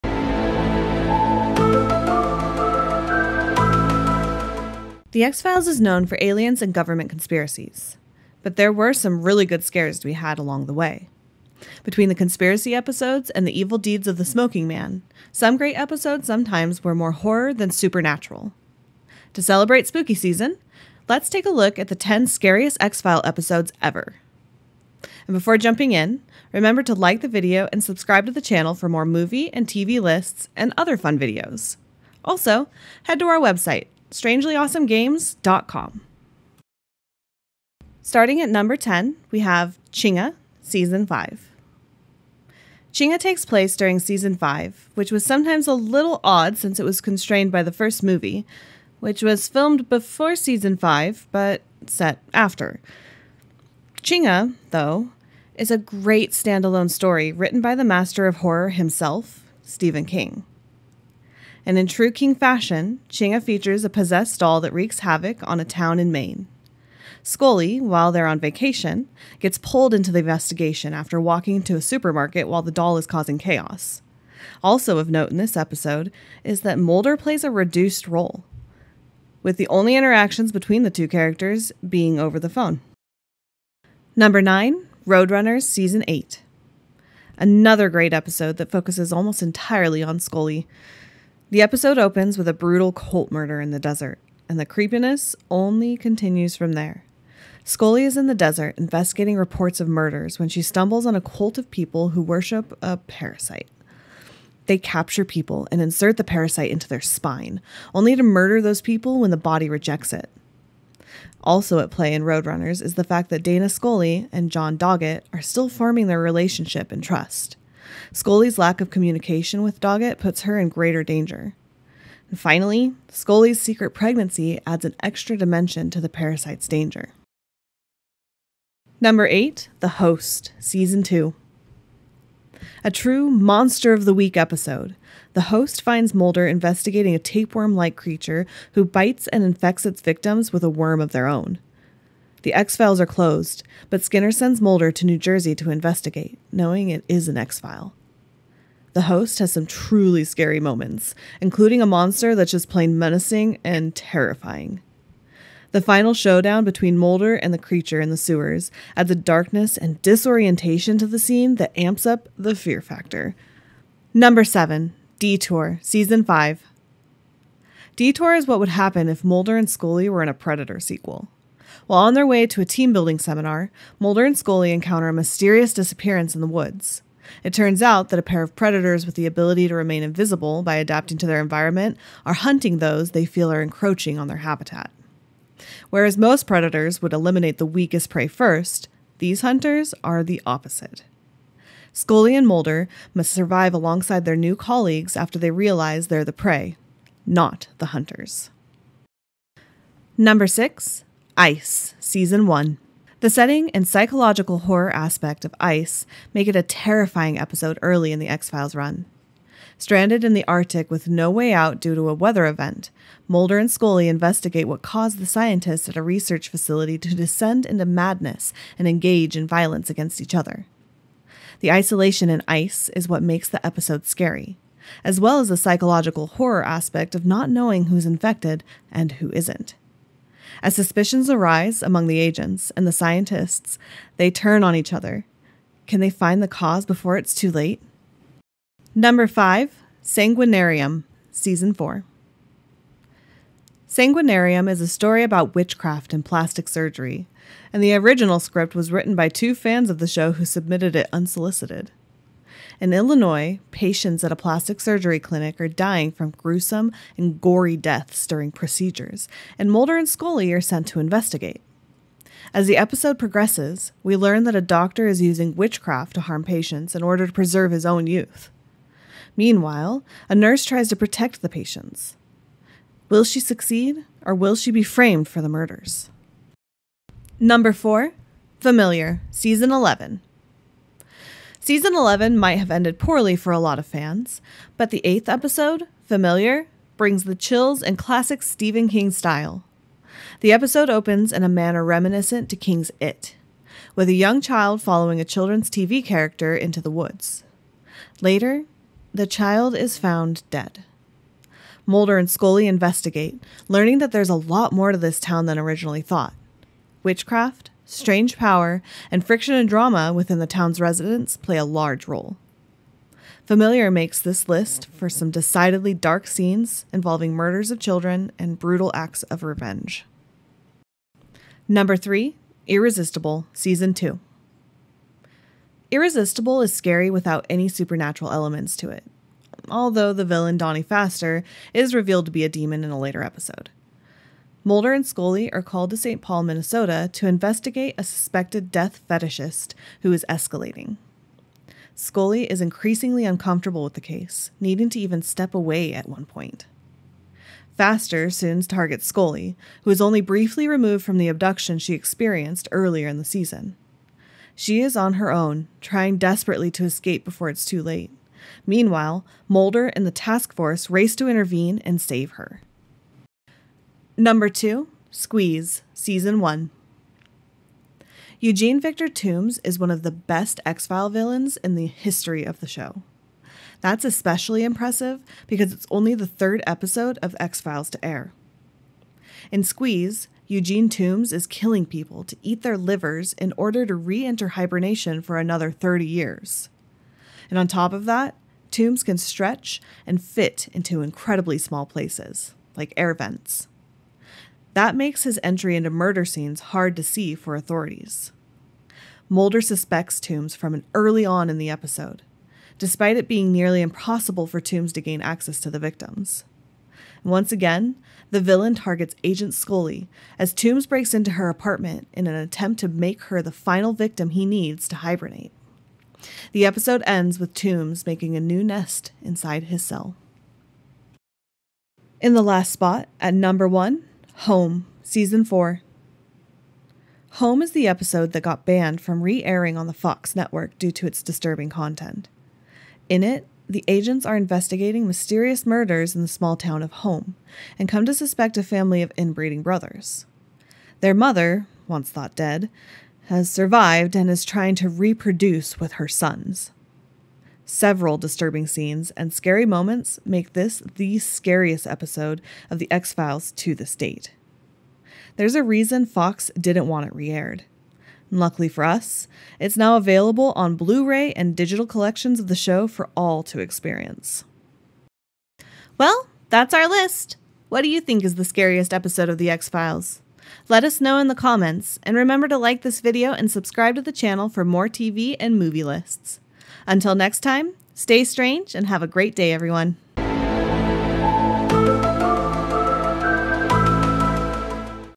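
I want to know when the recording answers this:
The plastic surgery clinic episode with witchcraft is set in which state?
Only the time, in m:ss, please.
4:12.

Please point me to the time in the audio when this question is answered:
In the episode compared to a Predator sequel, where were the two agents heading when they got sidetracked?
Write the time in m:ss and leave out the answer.
2:52.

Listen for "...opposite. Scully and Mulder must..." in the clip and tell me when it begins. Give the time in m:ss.
3:10.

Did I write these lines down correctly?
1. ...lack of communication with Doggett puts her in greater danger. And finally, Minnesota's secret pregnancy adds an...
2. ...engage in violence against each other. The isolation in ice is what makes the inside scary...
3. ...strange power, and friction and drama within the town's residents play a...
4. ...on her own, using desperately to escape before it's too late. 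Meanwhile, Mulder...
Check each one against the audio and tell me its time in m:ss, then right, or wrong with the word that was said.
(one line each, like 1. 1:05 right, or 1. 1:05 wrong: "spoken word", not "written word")
1. 1:58 wrong: "Scully", not "Minnesota"
2. 3:38 wrong: "episode", not "inside"
3. 5:07 right
4. 5:54 wrong: "trying", not "using".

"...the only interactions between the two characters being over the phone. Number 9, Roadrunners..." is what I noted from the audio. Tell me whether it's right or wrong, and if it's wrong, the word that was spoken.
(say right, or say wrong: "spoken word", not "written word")
right.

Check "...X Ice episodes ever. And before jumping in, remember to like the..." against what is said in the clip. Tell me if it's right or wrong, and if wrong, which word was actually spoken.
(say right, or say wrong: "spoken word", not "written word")
wrong: "File", not "Ice".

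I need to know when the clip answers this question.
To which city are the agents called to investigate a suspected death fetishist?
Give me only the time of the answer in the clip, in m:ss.
5:35.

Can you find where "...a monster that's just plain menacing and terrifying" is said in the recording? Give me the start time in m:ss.
2:31.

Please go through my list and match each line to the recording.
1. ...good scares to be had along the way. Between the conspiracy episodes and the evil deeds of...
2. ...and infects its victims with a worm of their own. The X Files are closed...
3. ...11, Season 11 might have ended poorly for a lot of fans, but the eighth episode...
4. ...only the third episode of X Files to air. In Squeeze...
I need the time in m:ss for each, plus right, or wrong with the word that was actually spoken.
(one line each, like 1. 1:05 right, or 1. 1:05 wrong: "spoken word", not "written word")
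1. 0:09 right
2. 2:19 right
3. 4:39 right
4. 6:15 right.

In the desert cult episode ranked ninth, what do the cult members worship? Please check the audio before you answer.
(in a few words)
A parasite.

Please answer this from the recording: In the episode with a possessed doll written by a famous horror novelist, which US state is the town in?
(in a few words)
Maine.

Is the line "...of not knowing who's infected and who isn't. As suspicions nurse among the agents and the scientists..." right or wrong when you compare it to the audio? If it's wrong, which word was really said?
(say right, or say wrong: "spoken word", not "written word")
wrong: "arise", not "nurse".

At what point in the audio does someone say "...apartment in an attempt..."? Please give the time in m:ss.
6:51.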